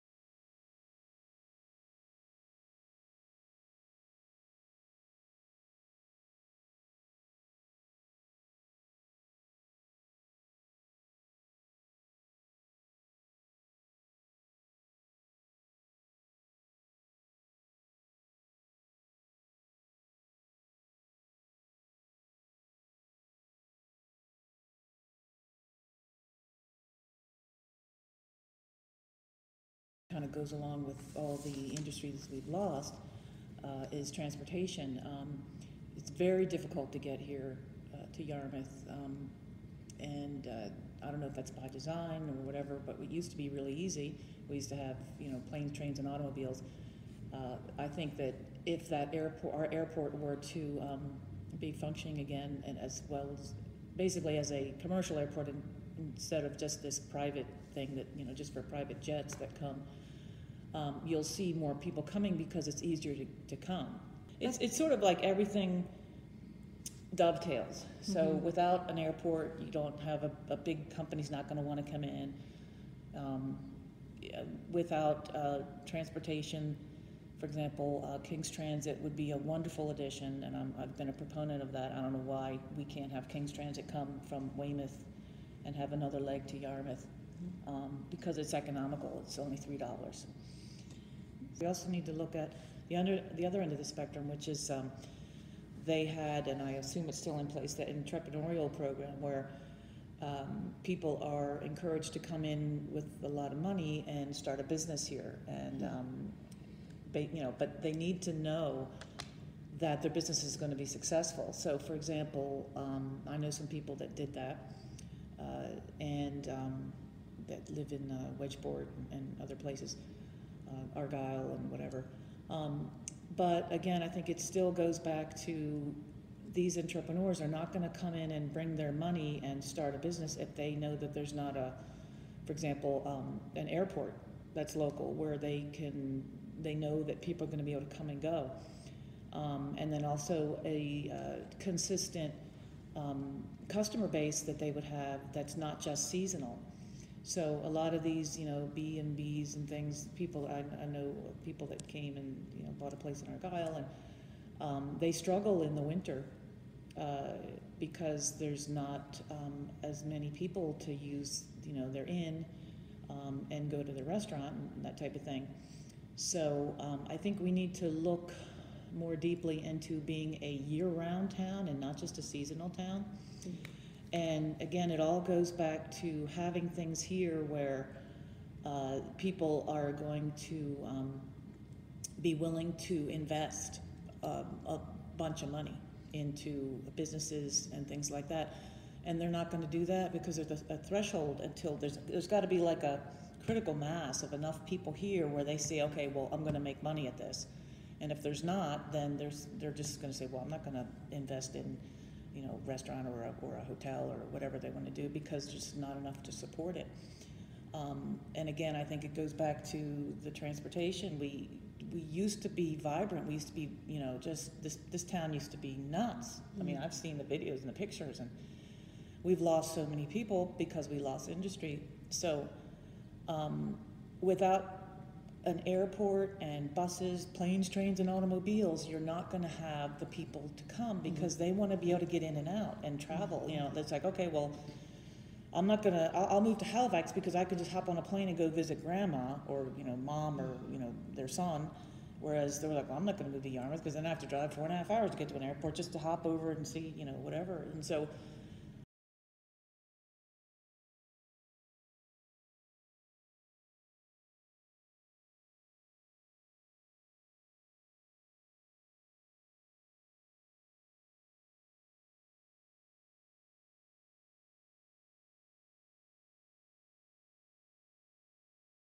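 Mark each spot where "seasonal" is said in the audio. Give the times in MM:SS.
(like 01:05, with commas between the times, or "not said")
02:26, 02:52.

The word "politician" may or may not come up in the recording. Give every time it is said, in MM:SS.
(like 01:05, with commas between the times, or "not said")
not said.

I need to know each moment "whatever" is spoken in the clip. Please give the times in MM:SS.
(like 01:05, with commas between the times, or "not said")
00:42, 02:01, 03:24, 04:07.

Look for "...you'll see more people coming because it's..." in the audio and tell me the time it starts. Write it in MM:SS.
01:01.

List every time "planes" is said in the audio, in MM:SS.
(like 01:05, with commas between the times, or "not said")
00:45, 03:47, 03:58.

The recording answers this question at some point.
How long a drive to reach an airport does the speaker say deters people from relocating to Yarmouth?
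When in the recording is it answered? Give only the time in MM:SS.
04:04.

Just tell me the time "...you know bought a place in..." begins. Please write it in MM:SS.
02:32.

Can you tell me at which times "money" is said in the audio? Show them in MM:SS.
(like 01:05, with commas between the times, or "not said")
01:43, 02:08, 03:05, 03:16.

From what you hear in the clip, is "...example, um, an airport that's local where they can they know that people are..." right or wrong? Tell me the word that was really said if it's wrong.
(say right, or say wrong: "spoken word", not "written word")
right.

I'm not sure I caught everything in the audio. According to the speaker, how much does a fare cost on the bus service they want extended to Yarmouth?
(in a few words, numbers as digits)
$3.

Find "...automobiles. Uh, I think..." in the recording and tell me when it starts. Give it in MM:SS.
00:46.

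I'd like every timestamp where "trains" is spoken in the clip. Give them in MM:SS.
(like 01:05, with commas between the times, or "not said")
00:45, 03:47.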